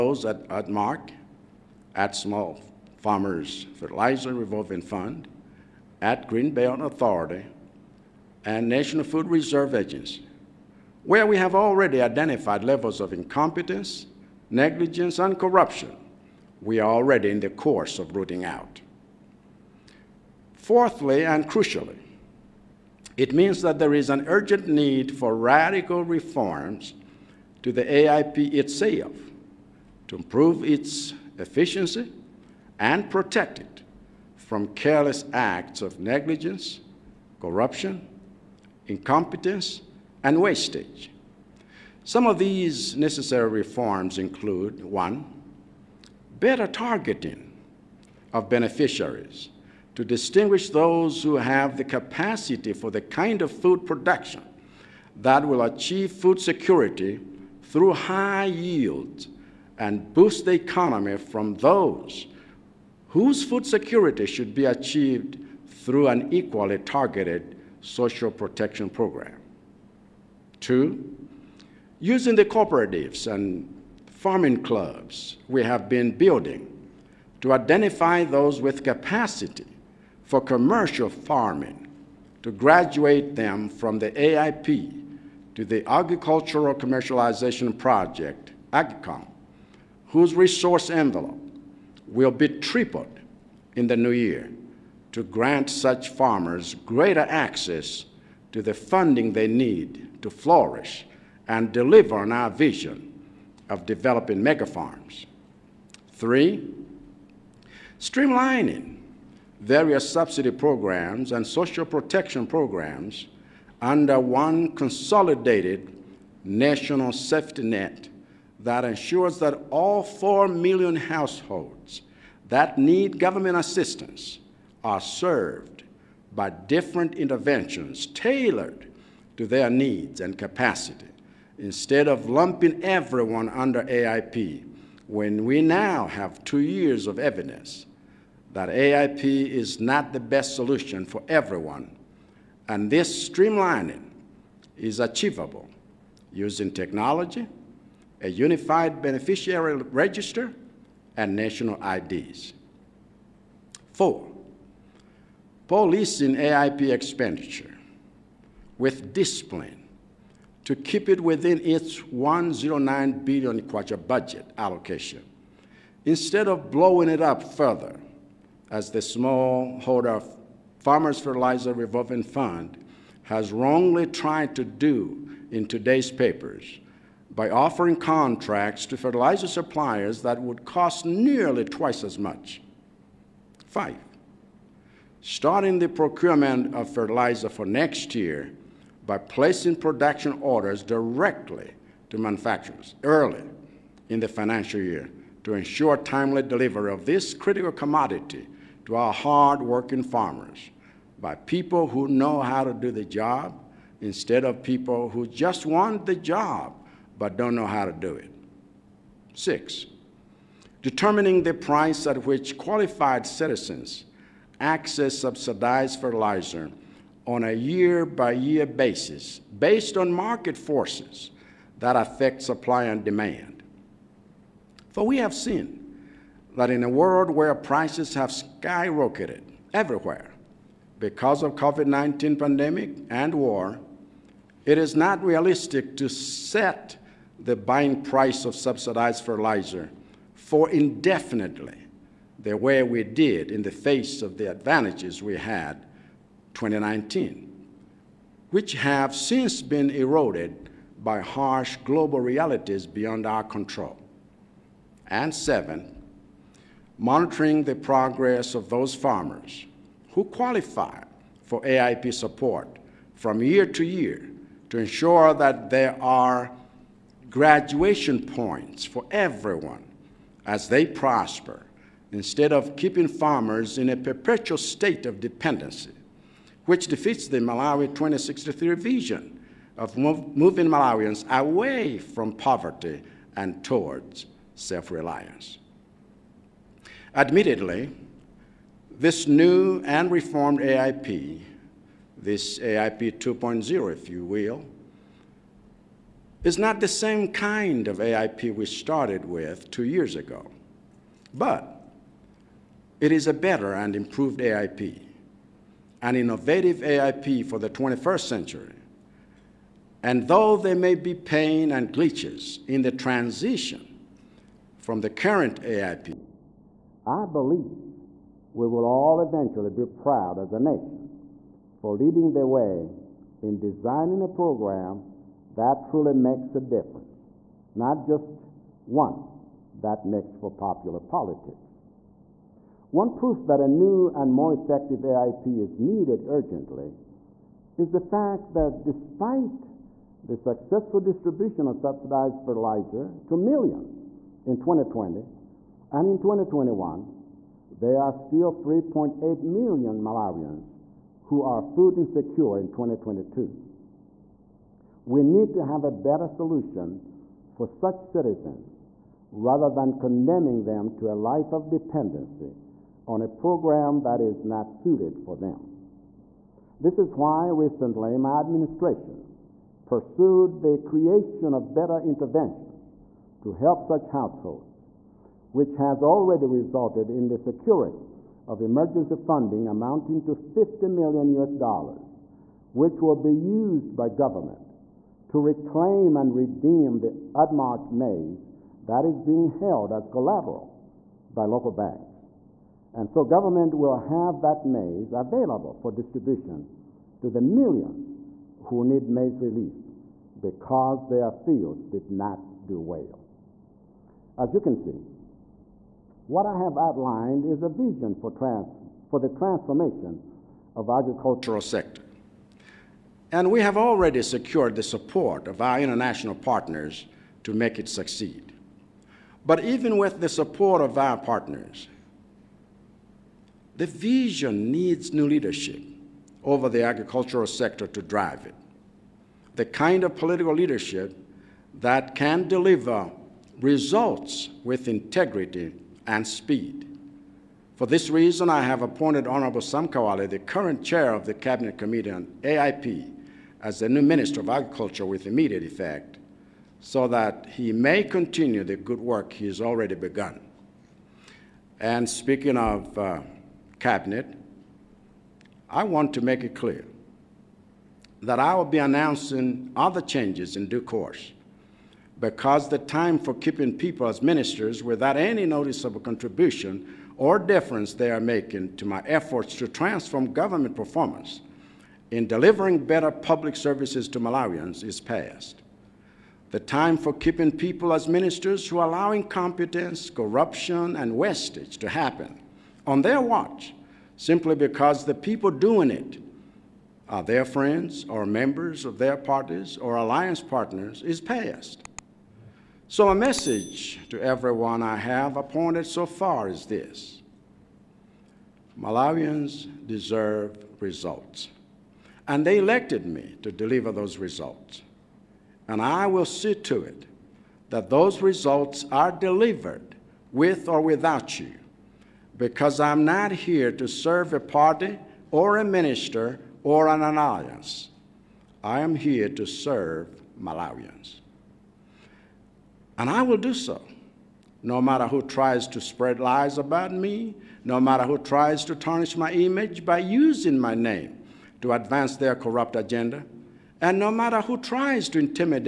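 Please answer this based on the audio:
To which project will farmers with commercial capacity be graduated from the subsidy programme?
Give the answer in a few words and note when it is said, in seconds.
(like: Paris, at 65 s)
Agricultural Commercialization Project, at 85 s.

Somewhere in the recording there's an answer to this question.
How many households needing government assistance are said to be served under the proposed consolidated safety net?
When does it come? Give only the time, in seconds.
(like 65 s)
120 s.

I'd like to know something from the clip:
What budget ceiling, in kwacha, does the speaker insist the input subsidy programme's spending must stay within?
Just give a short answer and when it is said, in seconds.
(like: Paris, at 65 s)
109 billion kwacha, at 161 s.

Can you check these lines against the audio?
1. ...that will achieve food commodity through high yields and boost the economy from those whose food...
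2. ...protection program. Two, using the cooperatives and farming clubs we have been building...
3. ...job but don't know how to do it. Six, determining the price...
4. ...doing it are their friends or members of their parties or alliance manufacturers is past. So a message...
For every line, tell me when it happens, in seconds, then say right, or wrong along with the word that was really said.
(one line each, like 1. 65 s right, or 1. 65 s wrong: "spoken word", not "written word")
1. 55 s wrong: "security", not "commodity"
2. 68 s right
3. 206 s right
4. 485 s wrong: "partners", not "manufacturers".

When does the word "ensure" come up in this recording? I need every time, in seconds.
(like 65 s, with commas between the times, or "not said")
118 s, 195 s, 264 s.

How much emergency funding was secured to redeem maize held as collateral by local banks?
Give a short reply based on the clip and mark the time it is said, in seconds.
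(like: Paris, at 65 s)
50 million US dollars, at 380 s.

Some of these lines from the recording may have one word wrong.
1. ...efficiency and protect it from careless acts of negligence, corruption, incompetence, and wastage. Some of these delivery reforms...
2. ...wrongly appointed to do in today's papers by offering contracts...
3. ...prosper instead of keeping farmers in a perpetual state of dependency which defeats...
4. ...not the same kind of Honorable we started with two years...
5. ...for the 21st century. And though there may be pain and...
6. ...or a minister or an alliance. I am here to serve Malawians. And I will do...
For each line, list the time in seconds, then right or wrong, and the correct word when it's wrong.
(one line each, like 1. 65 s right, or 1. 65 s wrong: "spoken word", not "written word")
1. 31 s wrong: "necessary", not "delivery"
2. 173 s wrong: "tried", not "appointed"
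3. 270 s right
4. 296 s wrong: "AIP", not "Honorable"
5. 307 s right
6. 515 s right.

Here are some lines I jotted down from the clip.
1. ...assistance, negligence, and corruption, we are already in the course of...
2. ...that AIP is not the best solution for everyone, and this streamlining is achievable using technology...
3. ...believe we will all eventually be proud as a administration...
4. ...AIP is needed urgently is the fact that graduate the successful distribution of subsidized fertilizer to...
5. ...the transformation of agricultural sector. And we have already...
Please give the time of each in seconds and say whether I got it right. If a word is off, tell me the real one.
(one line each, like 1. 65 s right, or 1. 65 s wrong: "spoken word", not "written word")
1. 13 s wrong: "incompetence", not "assistance"
2. 138 s right
3. 317 s wrong: "nation", not "administration"
4. 335 s wrong: "despite", not "graduate"
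5. 409 s right.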